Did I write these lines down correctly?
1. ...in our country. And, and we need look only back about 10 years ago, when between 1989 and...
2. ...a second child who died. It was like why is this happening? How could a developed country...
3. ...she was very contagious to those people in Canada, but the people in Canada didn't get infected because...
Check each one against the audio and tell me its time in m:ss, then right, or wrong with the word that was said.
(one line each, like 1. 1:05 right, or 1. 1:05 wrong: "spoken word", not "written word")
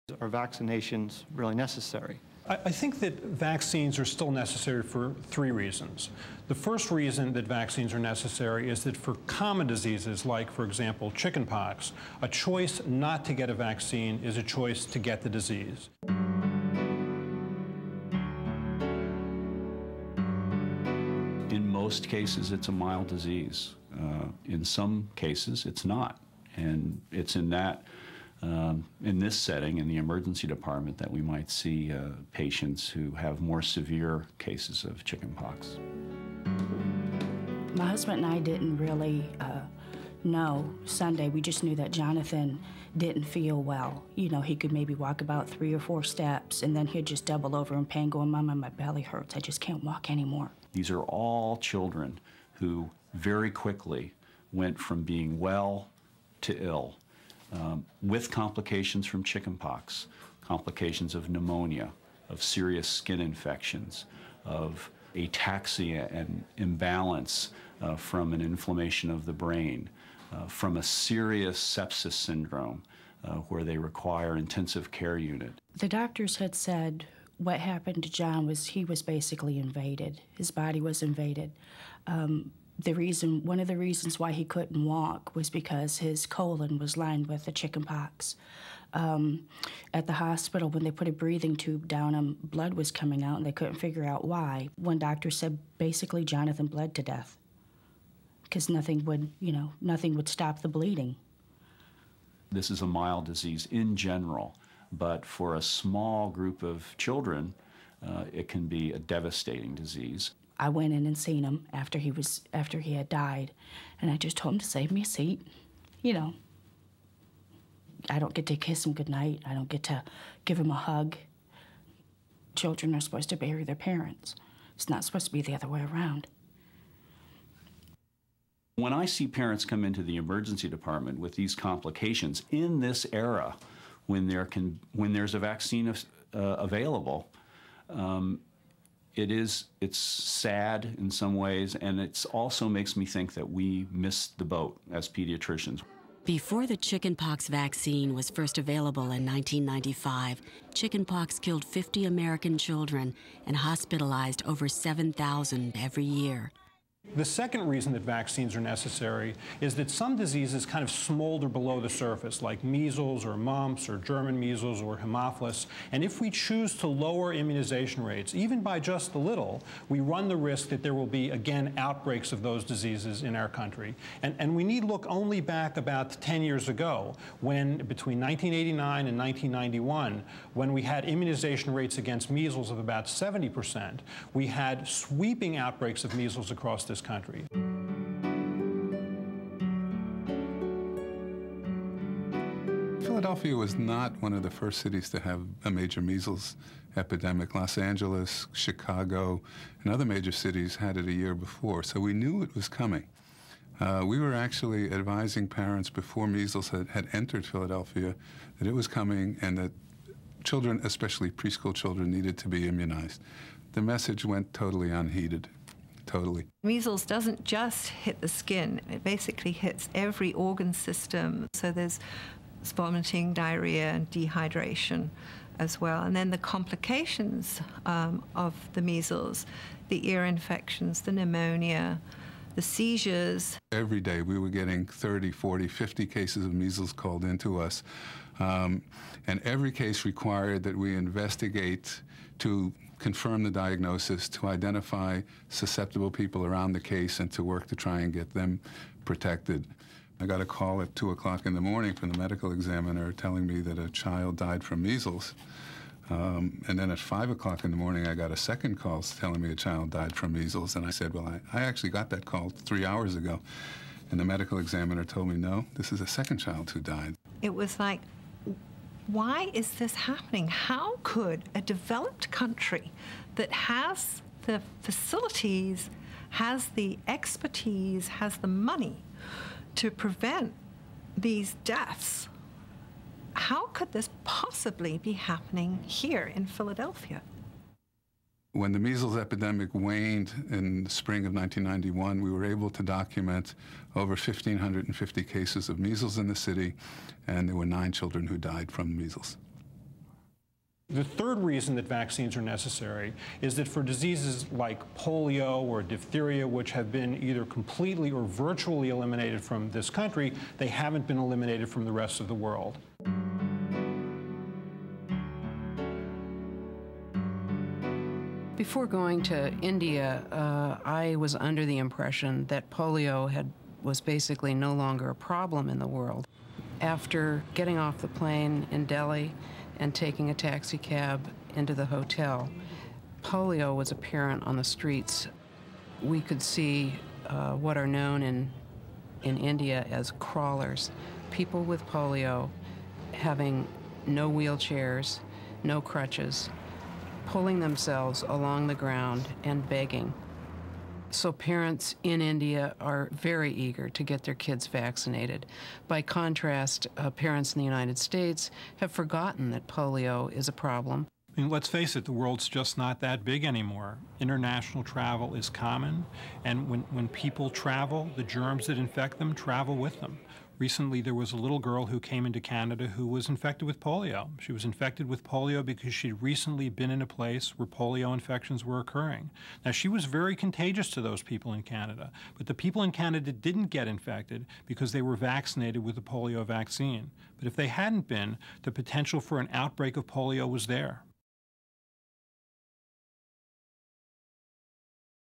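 1. 2:53 right
2. 4:26 right
3. 6:19 right.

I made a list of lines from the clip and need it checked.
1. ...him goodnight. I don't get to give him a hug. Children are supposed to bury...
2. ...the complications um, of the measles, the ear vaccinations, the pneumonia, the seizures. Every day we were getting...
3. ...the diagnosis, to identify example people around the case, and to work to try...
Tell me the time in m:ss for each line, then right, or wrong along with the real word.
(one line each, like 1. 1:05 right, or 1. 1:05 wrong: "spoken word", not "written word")
1. 1:58 right
2. 3:46 wrong: "infections", not "vaccinations"
3. 4:03 wrong: "susceptible", not "example".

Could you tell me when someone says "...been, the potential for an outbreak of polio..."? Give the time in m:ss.
6:28.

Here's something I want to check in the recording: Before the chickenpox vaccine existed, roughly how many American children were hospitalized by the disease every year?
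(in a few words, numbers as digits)
over 7,000.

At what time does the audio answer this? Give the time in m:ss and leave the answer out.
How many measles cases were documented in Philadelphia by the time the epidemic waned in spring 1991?
4:53.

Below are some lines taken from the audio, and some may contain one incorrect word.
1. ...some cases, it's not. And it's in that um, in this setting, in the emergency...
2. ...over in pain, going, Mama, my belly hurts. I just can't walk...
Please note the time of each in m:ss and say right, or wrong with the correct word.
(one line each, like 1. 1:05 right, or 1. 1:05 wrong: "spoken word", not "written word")
1. 0:24 right
2. 0:47 right.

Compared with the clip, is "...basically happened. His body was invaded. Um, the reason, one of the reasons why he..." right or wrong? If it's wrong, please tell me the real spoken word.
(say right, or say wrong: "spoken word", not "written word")
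wrong: "invaded", not "happened".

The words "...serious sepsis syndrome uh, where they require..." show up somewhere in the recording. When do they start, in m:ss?
1:10.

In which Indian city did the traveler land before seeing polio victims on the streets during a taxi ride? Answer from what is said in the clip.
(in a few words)
Delhi.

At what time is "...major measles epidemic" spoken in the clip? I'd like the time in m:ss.
3:15.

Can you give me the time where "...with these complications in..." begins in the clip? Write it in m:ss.
2:11.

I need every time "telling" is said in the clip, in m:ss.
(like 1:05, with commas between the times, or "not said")
4:13, 4:19.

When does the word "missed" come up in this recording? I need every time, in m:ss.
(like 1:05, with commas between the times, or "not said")
2:23.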